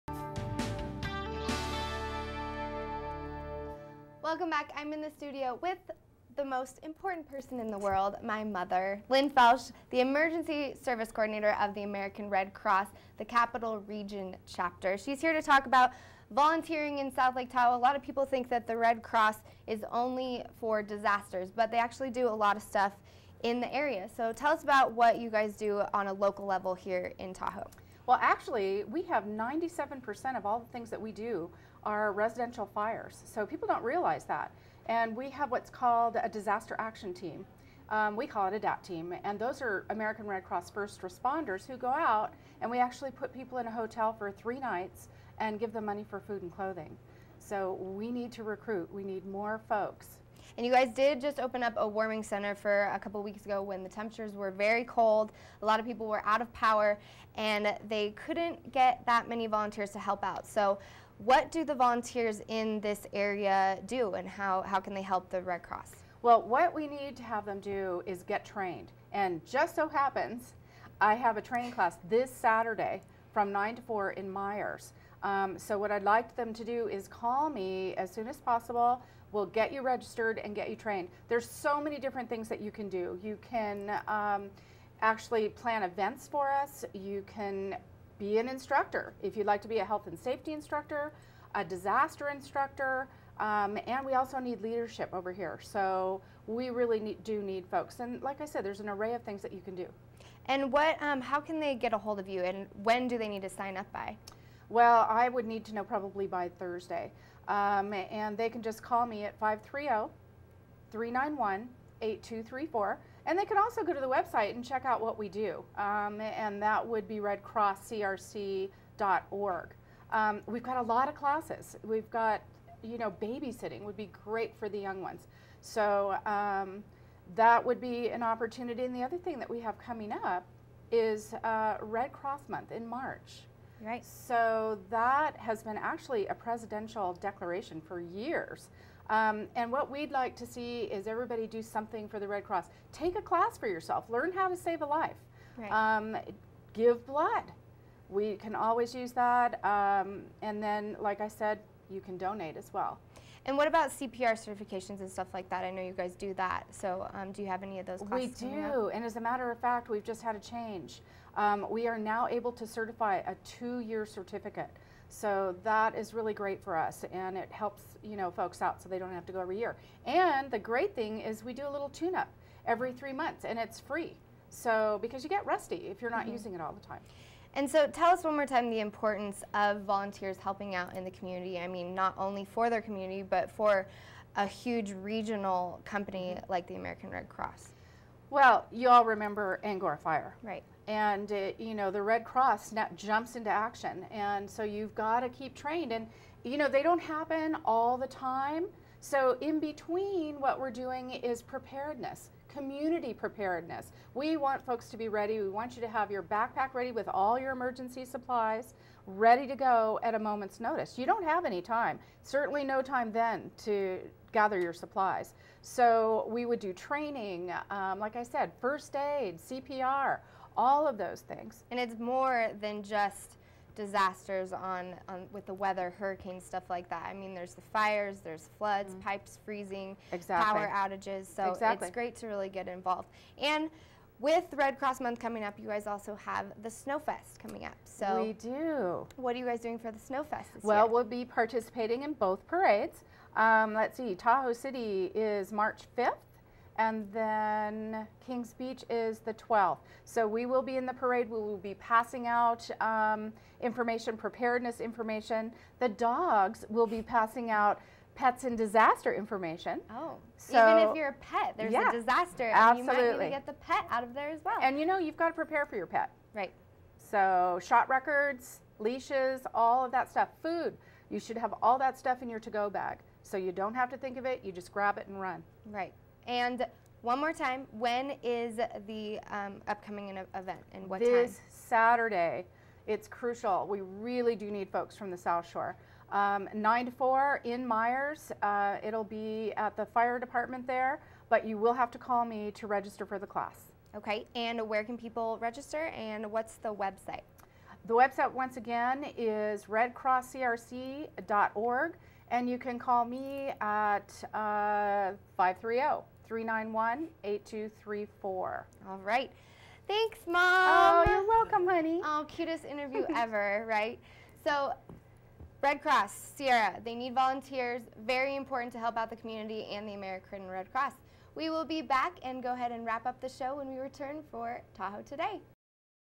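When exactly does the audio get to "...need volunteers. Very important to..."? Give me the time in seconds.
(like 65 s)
316 s.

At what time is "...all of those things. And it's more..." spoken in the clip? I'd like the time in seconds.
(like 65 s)
220 s.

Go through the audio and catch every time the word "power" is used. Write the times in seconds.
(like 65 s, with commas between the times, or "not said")
56 s, 230 s.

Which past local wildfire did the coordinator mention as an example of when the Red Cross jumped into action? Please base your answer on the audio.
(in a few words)
Angora Fire.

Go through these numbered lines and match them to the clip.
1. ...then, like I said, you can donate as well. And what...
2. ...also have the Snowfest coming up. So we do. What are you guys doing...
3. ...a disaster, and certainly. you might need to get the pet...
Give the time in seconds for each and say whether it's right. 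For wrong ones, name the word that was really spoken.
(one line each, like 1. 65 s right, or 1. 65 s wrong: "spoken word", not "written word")
1. 150 s right
2. 235 s right
3. 261 s wrong: "absolutely", not "certainly".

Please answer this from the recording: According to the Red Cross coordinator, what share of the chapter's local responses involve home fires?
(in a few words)
97%.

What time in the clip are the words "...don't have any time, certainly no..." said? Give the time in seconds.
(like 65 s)
211 s.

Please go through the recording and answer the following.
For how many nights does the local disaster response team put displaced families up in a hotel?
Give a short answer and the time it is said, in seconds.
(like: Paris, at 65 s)
3, at 44 s.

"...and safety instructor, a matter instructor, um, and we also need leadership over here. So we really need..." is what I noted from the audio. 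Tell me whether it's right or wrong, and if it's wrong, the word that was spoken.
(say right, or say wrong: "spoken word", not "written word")
wrong: "disaster", not "matter".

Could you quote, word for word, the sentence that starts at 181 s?
I mean, not only for their community, but for a huge regional company mm-hmm.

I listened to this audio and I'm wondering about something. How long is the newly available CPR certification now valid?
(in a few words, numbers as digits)
2 years.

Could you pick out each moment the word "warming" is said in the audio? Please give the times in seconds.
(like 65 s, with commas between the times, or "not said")
51 s.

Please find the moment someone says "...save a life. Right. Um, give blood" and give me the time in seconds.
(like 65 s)
144 s.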